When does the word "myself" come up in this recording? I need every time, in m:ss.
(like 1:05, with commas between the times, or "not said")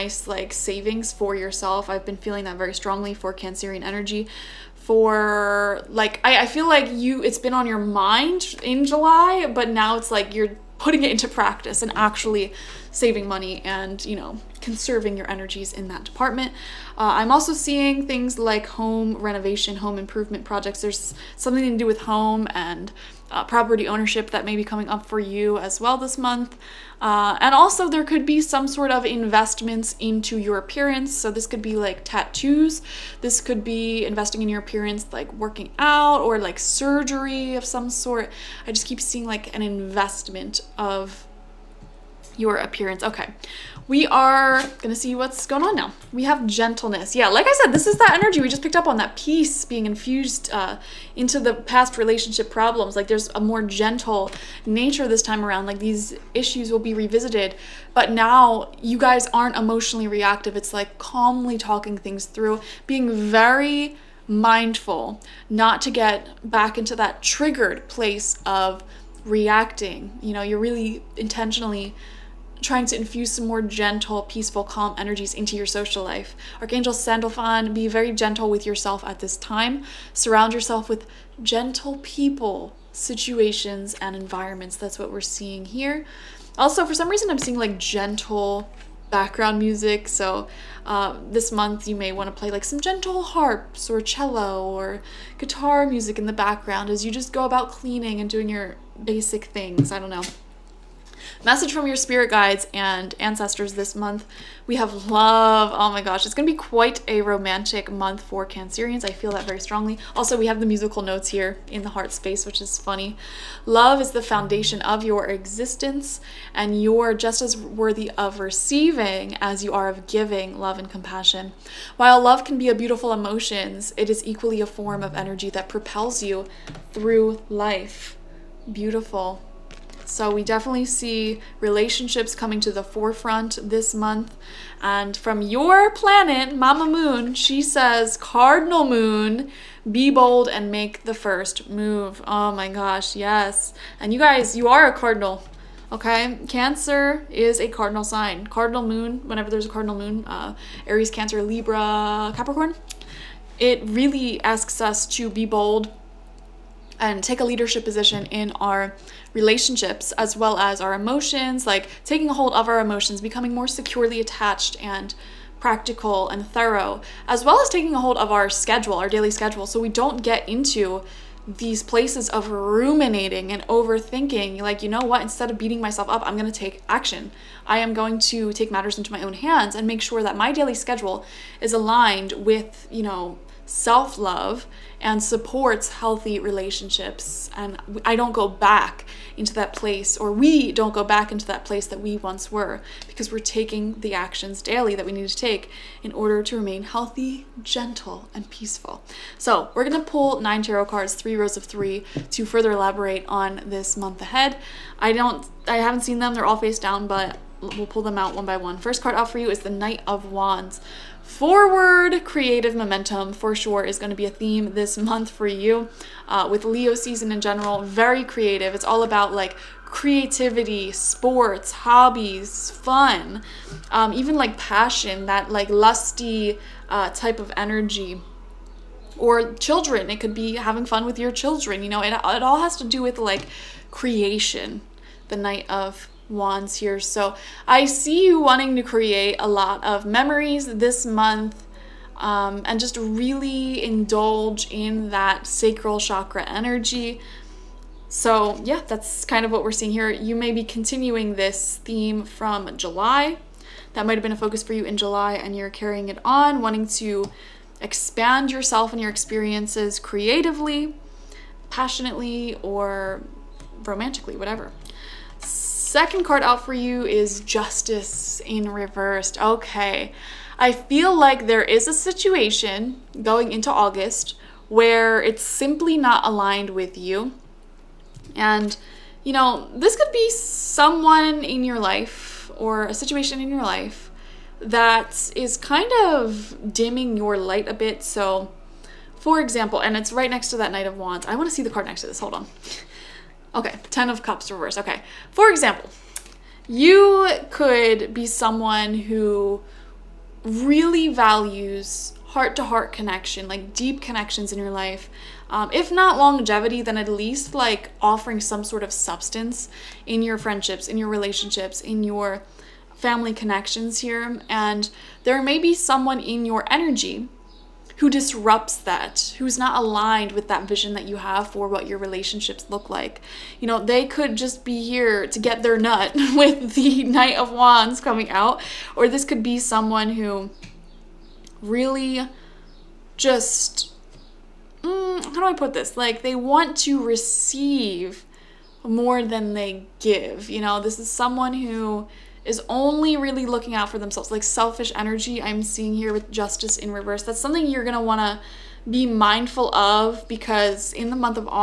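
2:55.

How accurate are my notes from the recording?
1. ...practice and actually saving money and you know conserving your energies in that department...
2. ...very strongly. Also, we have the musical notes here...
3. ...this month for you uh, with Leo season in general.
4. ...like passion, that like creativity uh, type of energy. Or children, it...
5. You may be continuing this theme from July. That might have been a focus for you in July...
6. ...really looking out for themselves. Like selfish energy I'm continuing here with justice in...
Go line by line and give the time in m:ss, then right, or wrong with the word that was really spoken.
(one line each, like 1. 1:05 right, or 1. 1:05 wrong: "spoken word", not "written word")
1. 0:11 right
2. 1:49 right
3. 3:34 right
4. 3:44 wrong: "lusty", not "creativity"
5. 4:10 right
6. 5:43 wrong: "seeing", not "continuing".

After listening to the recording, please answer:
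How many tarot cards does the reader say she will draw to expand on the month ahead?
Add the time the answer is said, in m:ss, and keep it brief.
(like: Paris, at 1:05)
9, at 3:20.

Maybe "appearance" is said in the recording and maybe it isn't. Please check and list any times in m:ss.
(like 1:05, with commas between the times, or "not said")
0:30, 0:34, 0:42.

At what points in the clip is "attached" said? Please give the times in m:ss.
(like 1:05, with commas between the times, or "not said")
2:44.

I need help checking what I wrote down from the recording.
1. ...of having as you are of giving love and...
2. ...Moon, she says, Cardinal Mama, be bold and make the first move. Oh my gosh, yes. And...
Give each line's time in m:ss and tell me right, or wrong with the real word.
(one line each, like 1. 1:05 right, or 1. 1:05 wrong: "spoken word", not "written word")
1. 1:58 wrong: "receiving", not "having"
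2. 2:16 wrong: "Moon", not "Mama".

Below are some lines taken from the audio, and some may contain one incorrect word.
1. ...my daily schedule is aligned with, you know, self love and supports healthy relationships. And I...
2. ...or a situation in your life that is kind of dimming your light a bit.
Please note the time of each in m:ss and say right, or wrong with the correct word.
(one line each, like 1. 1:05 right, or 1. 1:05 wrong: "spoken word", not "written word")
1. 3:00 right
2. 4:42 right.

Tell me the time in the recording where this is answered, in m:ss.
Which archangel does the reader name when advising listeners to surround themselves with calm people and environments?
1:16.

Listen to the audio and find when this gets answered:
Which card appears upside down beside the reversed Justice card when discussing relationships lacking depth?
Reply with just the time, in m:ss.
4:53.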